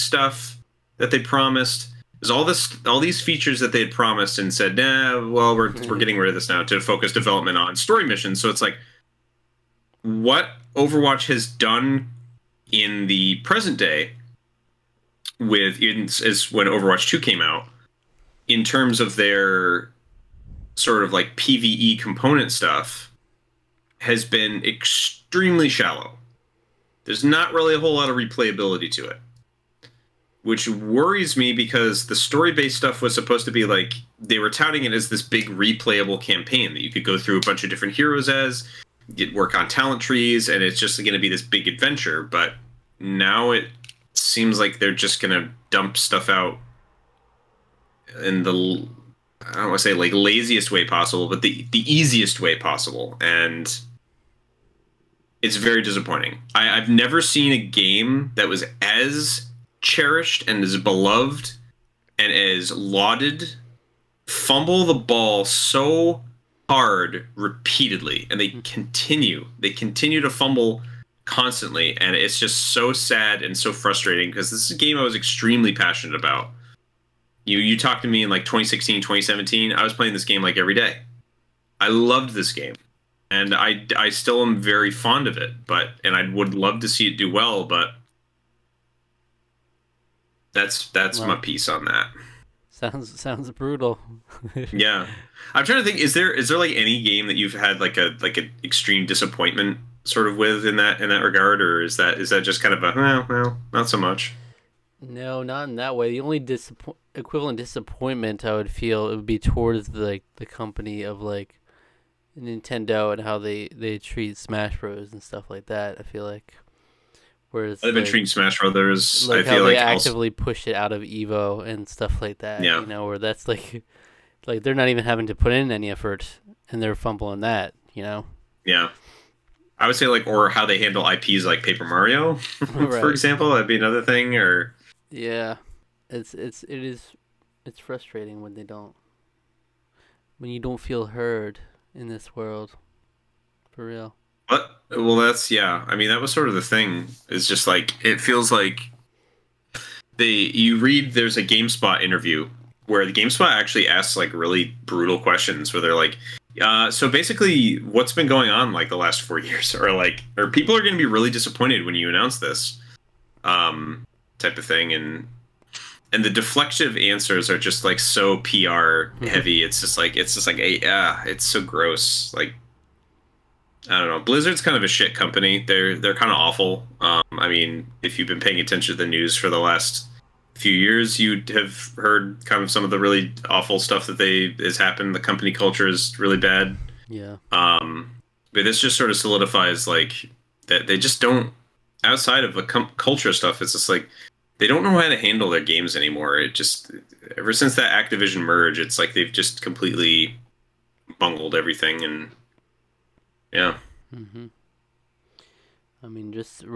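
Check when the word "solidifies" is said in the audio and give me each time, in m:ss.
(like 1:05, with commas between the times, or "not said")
3:09.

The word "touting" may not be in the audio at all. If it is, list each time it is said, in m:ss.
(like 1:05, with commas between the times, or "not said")
0:34.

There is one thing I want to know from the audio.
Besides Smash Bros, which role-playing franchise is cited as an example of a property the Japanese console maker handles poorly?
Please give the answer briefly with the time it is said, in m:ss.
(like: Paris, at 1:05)
Paper Mario, at 2:11.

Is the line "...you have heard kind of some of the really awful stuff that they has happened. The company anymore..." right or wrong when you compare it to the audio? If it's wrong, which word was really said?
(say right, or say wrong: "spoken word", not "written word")
wrong: "culture", not "anymore".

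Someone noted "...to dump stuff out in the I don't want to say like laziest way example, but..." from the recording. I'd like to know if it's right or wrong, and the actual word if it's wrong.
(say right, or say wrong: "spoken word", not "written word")
wrong: "possible", not "example".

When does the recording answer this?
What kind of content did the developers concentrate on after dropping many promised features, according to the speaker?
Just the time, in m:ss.
0:07.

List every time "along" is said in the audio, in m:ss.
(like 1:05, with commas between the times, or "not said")
not said.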